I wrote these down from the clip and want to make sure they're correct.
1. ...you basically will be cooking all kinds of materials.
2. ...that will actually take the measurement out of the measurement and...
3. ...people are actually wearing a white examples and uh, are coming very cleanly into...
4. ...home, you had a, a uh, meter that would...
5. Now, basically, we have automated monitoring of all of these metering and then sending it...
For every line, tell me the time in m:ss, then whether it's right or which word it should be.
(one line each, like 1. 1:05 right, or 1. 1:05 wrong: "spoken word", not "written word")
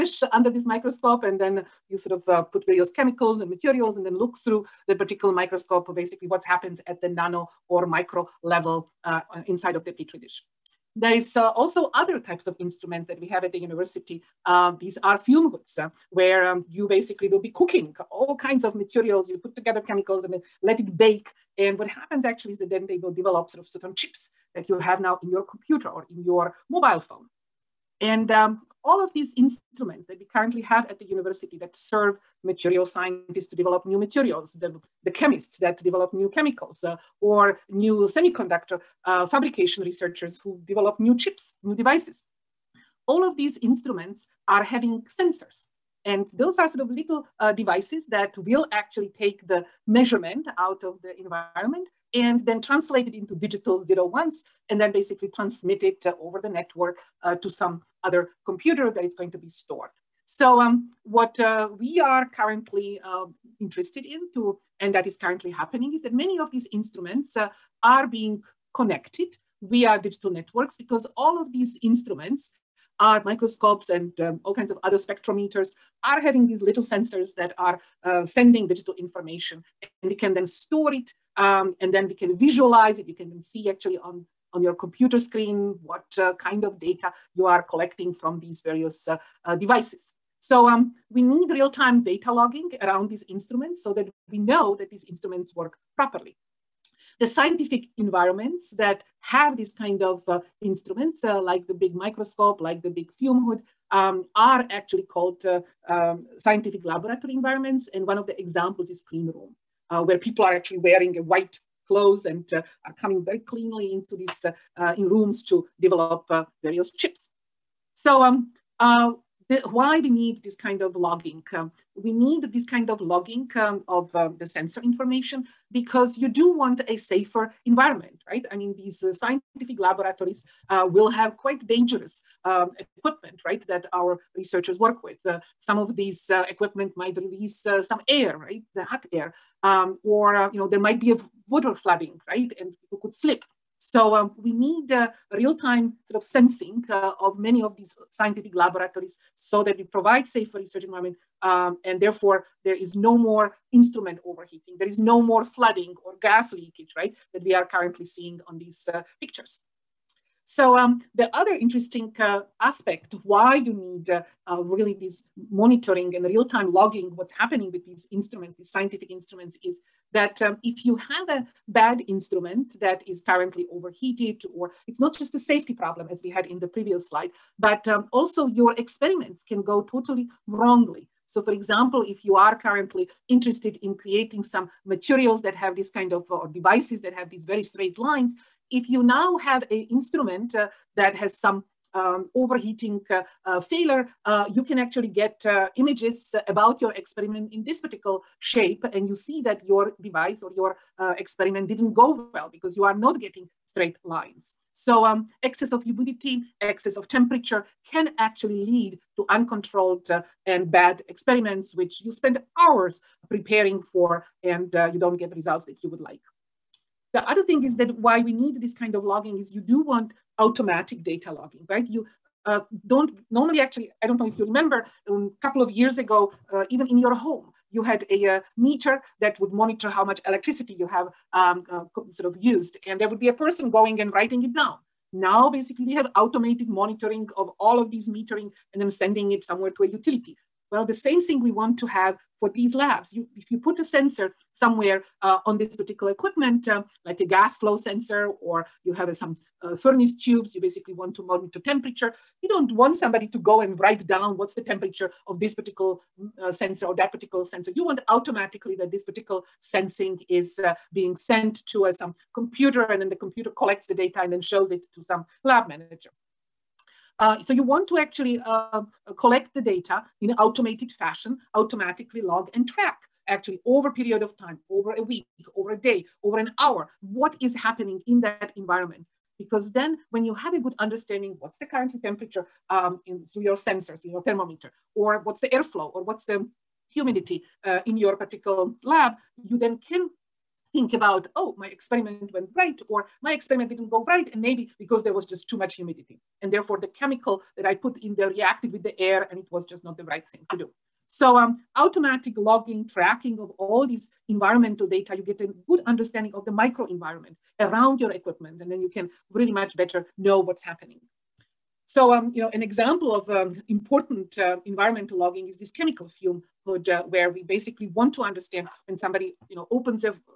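1. 0:16 right
2. 0:48 wrong: "environment", not "measurement"
3. 1:50 wrong: "clothes", not "examples"
4. 3:47 right
5. 3:55 right.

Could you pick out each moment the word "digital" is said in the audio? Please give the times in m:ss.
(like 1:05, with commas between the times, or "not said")
0:53, 1:09, 1:18.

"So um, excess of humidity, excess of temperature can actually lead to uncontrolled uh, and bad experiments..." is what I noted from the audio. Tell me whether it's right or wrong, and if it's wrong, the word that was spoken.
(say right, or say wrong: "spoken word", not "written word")
right.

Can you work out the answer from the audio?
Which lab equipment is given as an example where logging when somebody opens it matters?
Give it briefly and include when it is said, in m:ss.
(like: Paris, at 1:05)
chemical fume hood, at 5:15.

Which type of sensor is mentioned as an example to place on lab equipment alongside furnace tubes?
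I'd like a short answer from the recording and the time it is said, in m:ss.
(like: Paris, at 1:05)
gas flow sensor, at 4:07.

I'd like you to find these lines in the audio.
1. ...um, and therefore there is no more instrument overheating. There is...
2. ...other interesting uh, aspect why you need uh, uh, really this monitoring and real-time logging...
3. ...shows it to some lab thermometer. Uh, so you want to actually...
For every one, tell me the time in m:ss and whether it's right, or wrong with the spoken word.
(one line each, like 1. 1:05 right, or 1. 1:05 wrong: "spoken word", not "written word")
1. 2:31 right
2. 2:41 right
3. 4:24 wrong: "manager", not "thermometer".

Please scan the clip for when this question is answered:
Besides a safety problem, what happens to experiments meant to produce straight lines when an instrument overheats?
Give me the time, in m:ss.
2:59.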